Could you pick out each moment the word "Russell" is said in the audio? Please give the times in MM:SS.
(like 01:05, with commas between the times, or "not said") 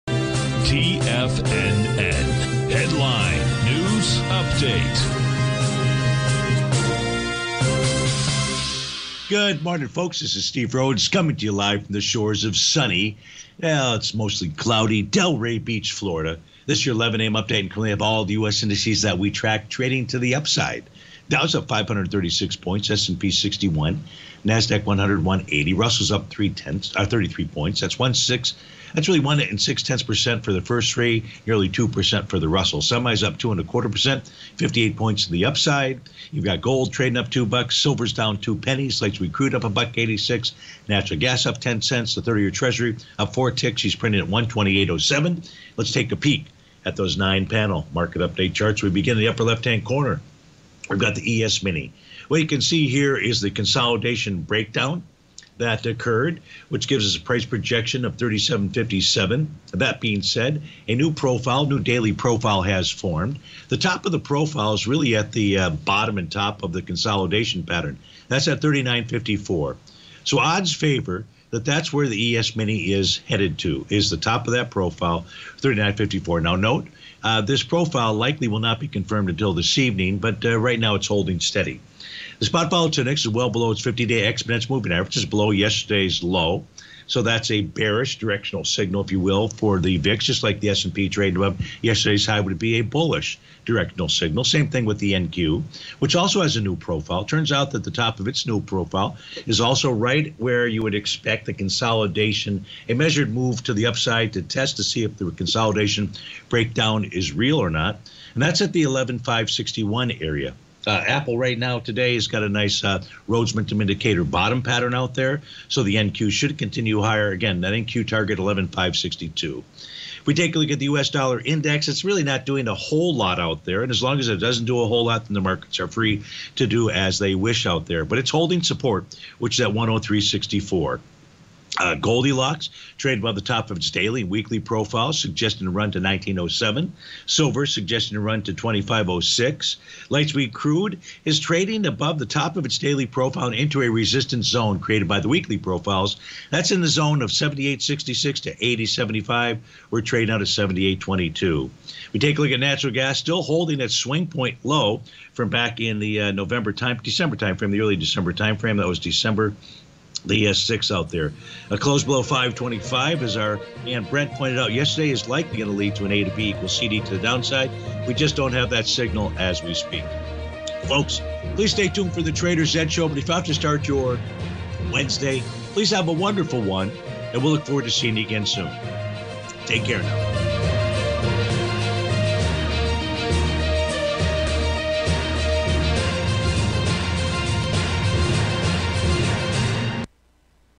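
00:25, 00:32.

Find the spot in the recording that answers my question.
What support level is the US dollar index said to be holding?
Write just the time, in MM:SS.
02:09.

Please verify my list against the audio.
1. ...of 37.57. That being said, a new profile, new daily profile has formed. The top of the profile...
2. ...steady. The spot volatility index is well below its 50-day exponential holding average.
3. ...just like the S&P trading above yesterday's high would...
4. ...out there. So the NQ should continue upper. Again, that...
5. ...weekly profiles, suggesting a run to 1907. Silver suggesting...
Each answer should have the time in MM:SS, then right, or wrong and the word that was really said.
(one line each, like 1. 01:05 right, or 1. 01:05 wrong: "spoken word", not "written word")
1. 00:58 right
2. 01:21 wrong: "moving", not "holding"
3. 01:30 right
4. 01:54 wrong: "higher", not "upper"
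5. 02:14 right.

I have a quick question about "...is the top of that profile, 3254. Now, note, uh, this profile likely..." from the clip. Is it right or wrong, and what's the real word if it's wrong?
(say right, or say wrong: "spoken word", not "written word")
wrong: "3954", not "3254".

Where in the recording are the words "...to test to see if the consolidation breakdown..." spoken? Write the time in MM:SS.
01:44.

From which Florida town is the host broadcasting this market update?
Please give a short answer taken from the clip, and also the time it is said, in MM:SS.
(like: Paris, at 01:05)
Delray Beach, at 00:15.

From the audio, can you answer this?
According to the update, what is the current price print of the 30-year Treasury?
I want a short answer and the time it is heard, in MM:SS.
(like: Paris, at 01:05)
128.07, at 00:44.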